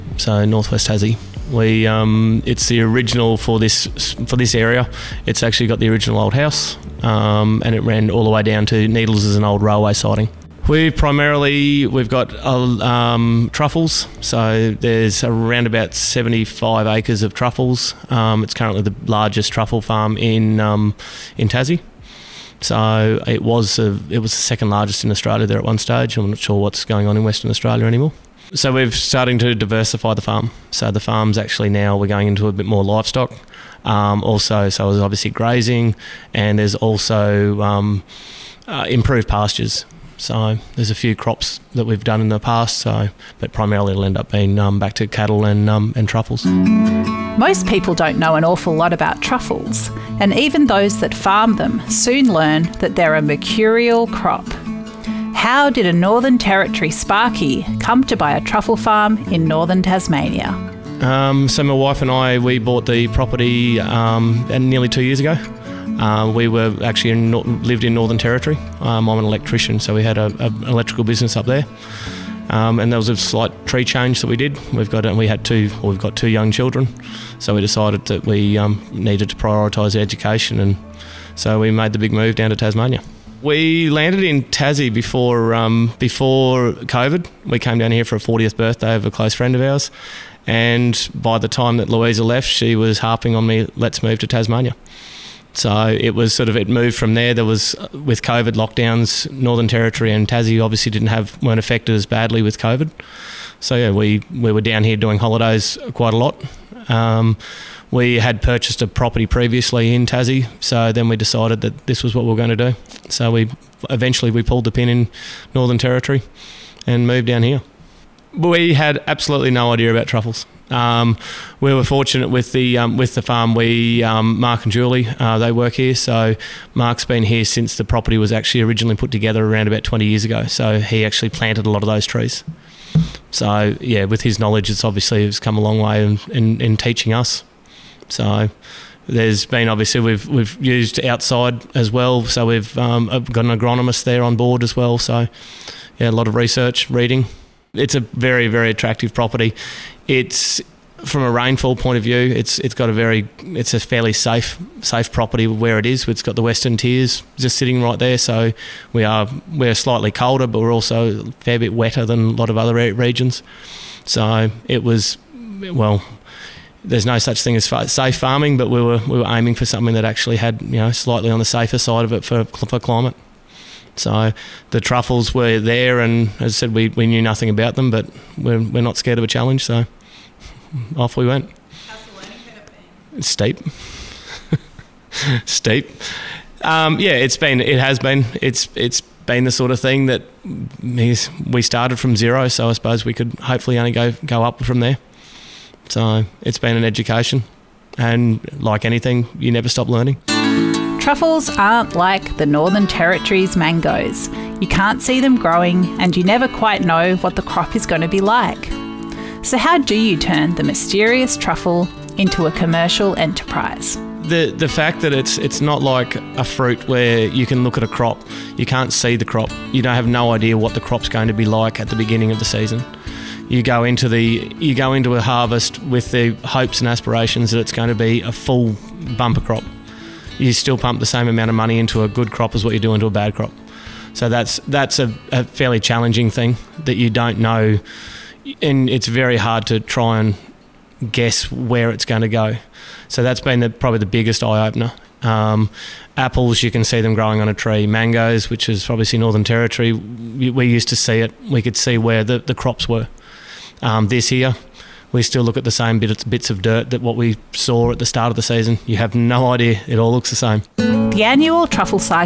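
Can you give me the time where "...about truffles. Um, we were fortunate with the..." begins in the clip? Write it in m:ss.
1:59.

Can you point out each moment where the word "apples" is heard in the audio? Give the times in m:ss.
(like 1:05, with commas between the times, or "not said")
4:06.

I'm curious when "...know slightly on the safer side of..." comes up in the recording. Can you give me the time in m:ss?
2:50.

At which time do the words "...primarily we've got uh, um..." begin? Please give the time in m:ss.
0:10.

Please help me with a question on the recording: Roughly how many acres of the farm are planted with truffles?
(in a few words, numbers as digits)
75 acres.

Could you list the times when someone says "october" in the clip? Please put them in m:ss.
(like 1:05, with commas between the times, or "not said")
not said.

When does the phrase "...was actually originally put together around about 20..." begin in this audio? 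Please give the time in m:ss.
2:08.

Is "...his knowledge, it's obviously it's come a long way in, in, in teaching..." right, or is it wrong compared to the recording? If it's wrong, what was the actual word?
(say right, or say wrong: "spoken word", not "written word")
right.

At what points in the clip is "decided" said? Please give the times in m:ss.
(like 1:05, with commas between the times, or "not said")
1:17, 1:51.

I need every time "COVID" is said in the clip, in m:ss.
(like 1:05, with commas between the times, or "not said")
1:26, 1:38, 1:42.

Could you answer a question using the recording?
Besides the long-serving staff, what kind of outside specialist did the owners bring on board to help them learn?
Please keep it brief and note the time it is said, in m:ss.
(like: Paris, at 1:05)
An agronomist, at 2:23.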